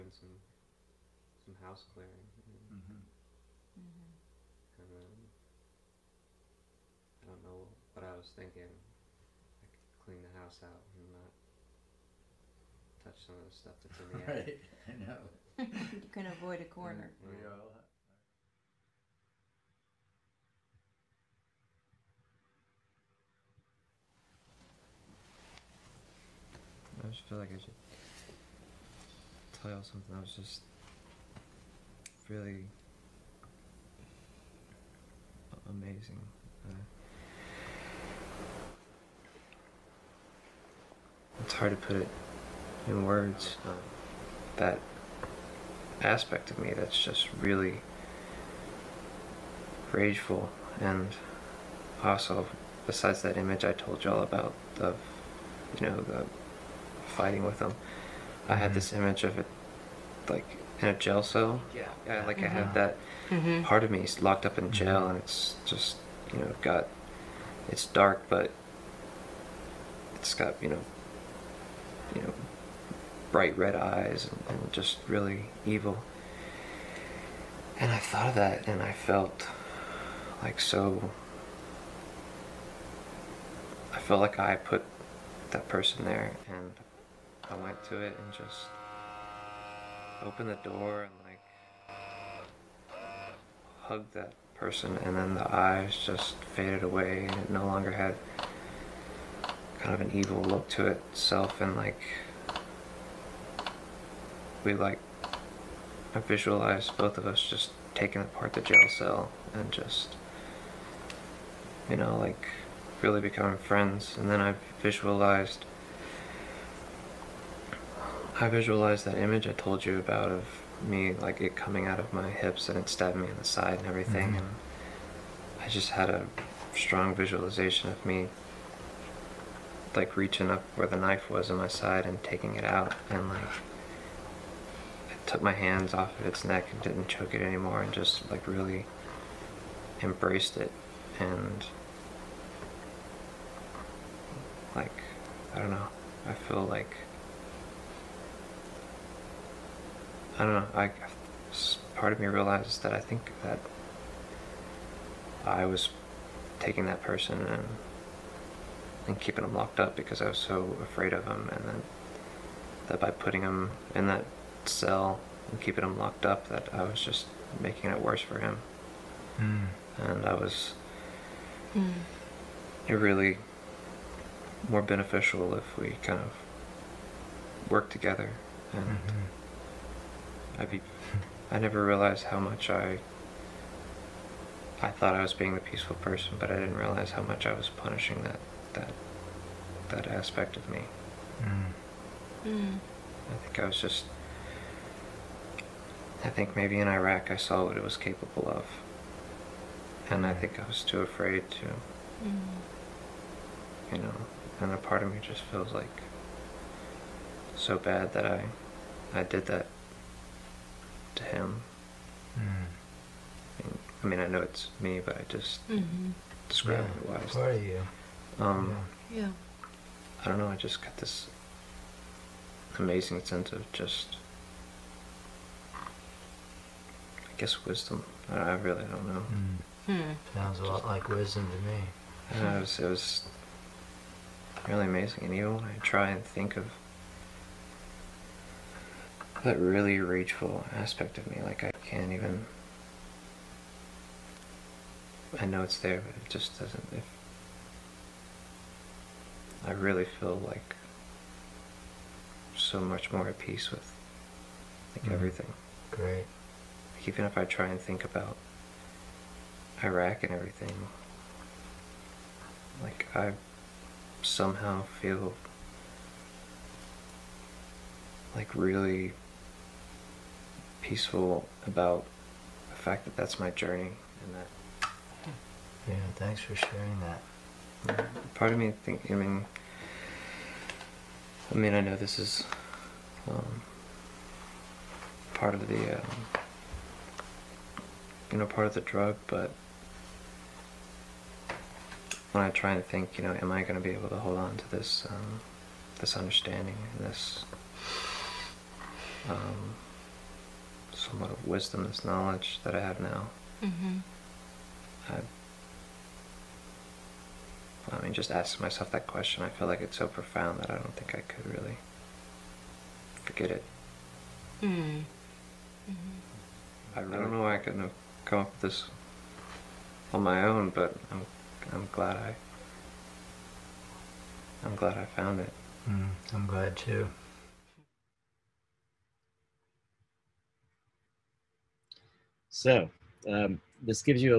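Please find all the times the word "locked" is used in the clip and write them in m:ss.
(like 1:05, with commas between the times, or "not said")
1:04, 2:39, 2:45.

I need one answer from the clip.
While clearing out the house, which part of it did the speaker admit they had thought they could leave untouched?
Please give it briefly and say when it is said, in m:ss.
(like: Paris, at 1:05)
attic, at 0:14.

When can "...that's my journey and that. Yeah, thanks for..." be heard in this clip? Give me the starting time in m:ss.
4:33.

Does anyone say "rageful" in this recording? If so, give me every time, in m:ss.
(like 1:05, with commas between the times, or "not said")
0:49, 3:59.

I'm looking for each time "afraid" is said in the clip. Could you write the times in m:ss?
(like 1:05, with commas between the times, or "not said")
2:40, 3:21.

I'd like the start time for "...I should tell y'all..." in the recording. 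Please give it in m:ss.
0:27.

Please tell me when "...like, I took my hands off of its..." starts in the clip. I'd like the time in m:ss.
2:13.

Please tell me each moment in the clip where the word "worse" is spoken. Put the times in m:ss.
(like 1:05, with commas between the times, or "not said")
2:48.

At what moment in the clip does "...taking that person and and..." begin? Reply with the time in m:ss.
2:36.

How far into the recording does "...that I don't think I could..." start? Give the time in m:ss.
5:10.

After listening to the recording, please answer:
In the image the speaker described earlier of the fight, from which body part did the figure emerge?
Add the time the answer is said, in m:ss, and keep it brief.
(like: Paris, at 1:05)
hips, at 2:02.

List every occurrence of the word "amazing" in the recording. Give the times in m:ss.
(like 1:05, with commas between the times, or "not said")
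0:35, 3:42, 3:54.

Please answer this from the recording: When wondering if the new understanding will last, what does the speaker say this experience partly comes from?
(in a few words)
the drug.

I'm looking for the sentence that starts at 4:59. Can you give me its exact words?
Um, somewhat of wisdom, this knowledge that I have now.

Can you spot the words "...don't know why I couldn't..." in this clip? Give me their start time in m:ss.
5:17.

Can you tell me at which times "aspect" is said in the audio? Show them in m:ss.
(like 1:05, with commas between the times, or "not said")
0:46, 3:10, 4:00.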